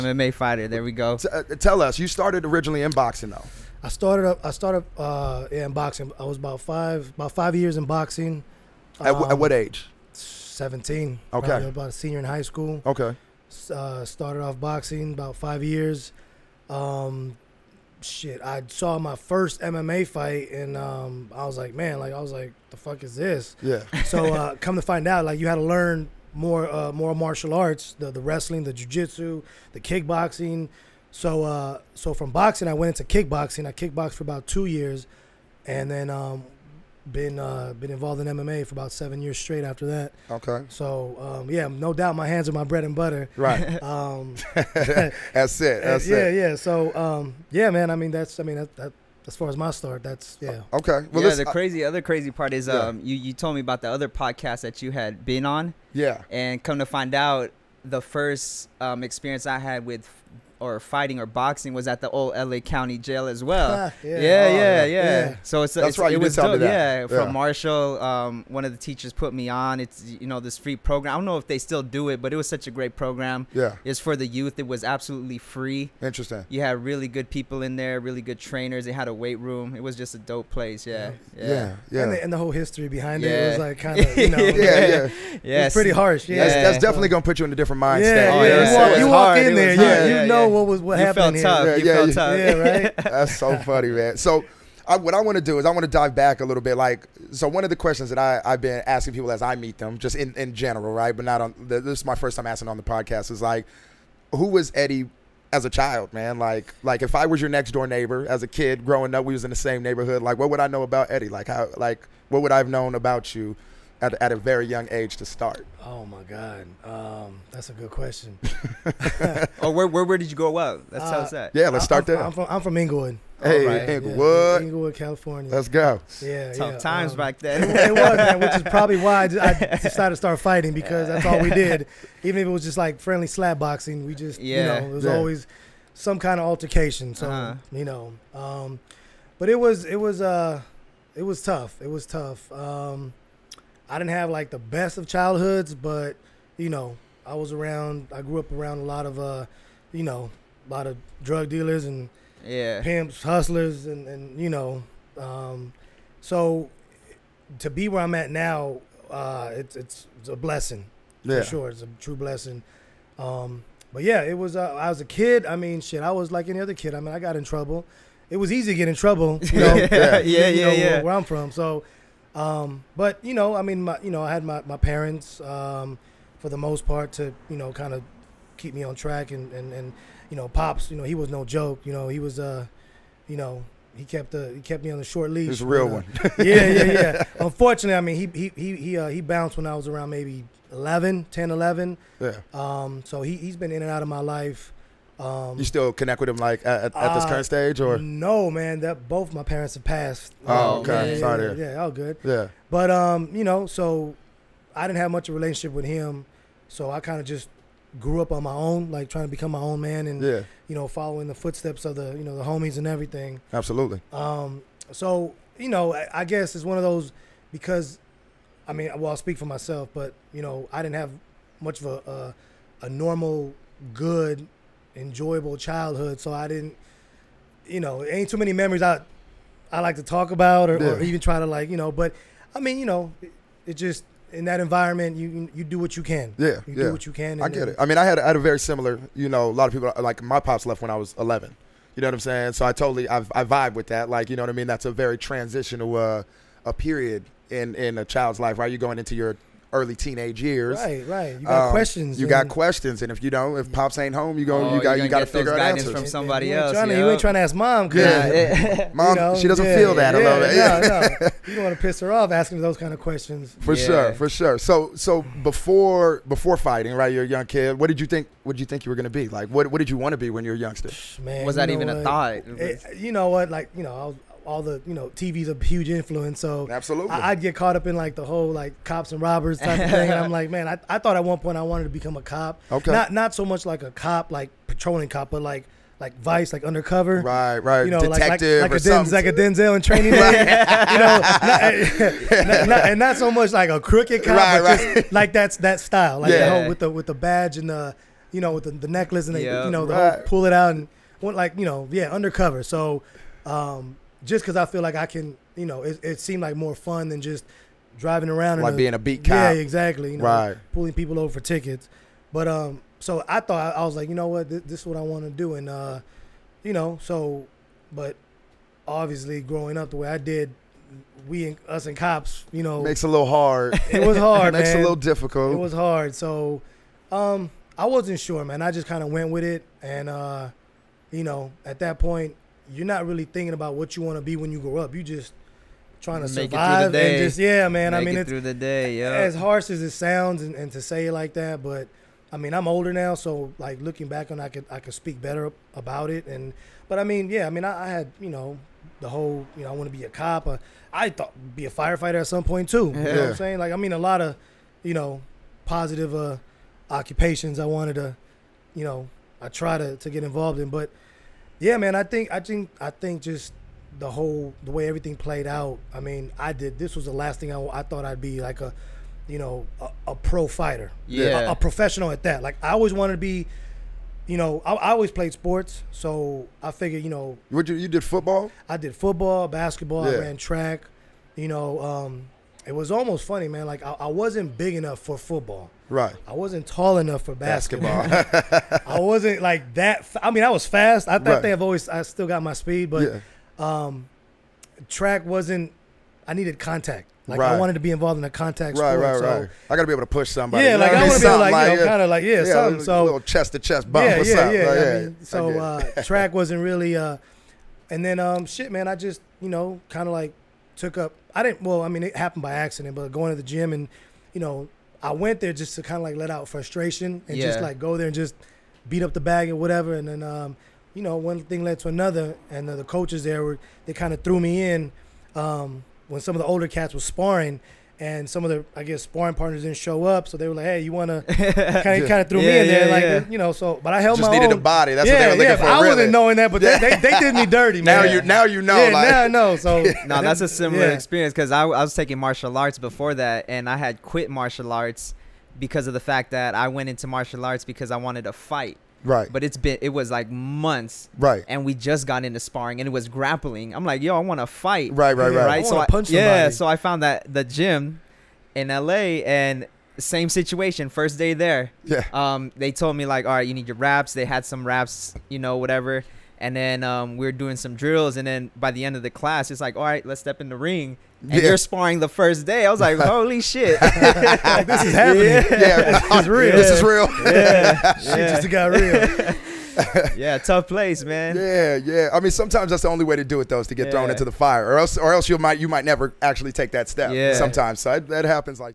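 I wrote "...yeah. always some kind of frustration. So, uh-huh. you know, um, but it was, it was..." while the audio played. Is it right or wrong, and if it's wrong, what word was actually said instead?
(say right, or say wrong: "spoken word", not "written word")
wrong: "altercation", not "frustration".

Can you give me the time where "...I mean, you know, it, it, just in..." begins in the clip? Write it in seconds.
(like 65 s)
232 s.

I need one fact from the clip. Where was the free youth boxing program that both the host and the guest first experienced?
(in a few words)
Old LA County Jail.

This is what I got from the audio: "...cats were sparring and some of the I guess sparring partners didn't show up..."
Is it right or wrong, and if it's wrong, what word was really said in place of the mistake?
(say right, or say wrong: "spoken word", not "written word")
right.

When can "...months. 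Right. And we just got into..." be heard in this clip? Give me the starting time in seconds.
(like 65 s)
450 s.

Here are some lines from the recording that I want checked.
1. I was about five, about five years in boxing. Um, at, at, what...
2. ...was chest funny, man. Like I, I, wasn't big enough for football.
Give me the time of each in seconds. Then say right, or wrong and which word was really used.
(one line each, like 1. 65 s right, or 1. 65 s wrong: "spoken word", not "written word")
1. 6 s right
2. 382 s wrong: "almost", not "chest".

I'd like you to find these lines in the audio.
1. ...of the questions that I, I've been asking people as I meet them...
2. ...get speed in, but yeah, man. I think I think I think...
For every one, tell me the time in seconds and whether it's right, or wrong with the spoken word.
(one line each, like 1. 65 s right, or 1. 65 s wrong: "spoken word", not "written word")
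1. 97 s right
2. 360 s wrong: "involved", not "speed".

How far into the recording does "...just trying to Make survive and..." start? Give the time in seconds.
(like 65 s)
335 s.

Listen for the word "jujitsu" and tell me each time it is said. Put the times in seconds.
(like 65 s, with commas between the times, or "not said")
28 s.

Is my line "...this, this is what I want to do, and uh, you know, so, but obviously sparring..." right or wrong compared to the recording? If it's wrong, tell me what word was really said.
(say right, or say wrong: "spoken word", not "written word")
wrong: "growing", not "sparring".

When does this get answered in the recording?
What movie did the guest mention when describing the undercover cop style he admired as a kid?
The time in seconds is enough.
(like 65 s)
289 s.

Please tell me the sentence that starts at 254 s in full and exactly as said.
Oh, you got you got to figure out answers from somebody you else.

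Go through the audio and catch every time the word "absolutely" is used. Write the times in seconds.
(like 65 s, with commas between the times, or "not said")
74 s, 213 s, 276 s.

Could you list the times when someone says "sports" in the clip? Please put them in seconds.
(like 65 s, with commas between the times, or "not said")
375 s, 398 s.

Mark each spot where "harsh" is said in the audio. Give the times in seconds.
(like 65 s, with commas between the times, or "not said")
85 s, 339 s.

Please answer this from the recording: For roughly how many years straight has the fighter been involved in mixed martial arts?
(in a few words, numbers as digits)
7.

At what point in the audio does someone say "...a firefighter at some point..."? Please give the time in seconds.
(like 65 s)
351 s.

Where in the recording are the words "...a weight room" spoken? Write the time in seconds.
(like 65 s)
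79 s.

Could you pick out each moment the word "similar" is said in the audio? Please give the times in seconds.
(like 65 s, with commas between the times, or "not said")
238 s, 440 s.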